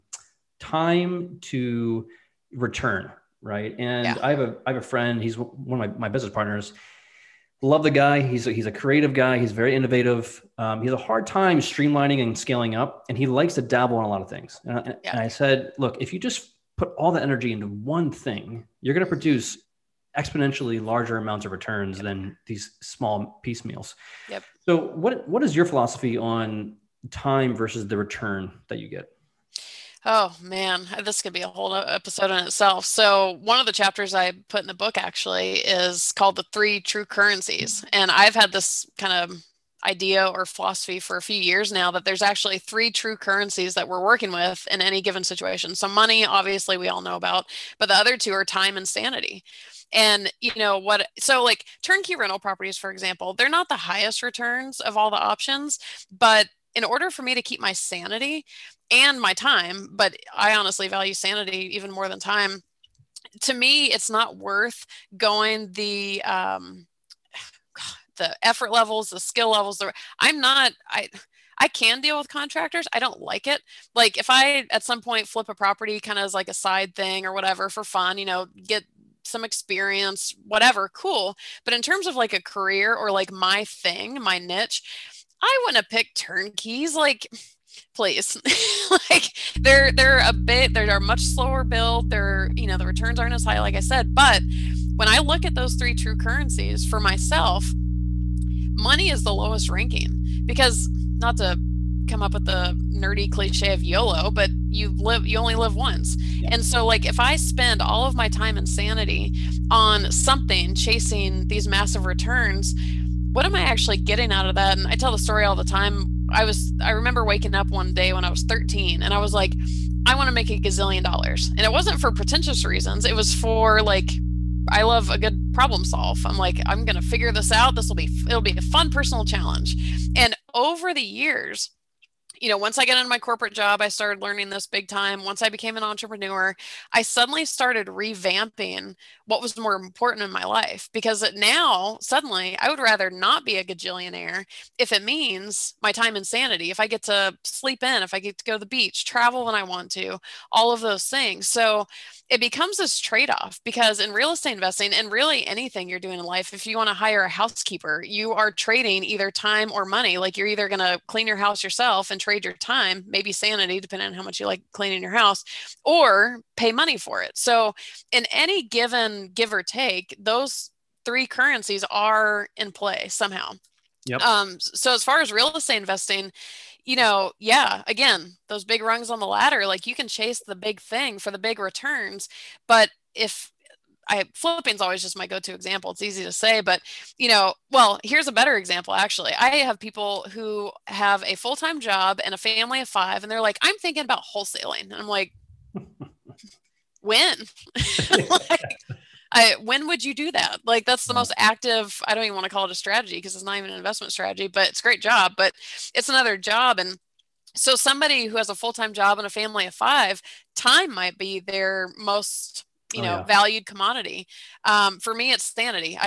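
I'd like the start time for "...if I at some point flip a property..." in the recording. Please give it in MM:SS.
01:14.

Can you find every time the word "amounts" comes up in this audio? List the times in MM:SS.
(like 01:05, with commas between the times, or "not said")
00:21.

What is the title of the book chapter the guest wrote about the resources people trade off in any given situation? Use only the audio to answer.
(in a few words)
The Three True Currencies.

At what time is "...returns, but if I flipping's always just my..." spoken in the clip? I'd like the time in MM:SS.
03:01.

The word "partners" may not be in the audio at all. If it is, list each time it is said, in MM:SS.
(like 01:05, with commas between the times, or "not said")
00:06.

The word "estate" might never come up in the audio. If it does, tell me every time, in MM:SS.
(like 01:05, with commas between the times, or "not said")
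02:34, 02:55.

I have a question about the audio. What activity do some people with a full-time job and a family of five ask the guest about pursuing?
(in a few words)
Wholesaling.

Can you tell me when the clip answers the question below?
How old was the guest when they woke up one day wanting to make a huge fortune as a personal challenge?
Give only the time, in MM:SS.
01:58.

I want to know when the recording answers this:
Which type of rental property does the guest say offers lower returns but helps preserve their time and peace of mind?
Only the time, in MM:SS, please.
00:51.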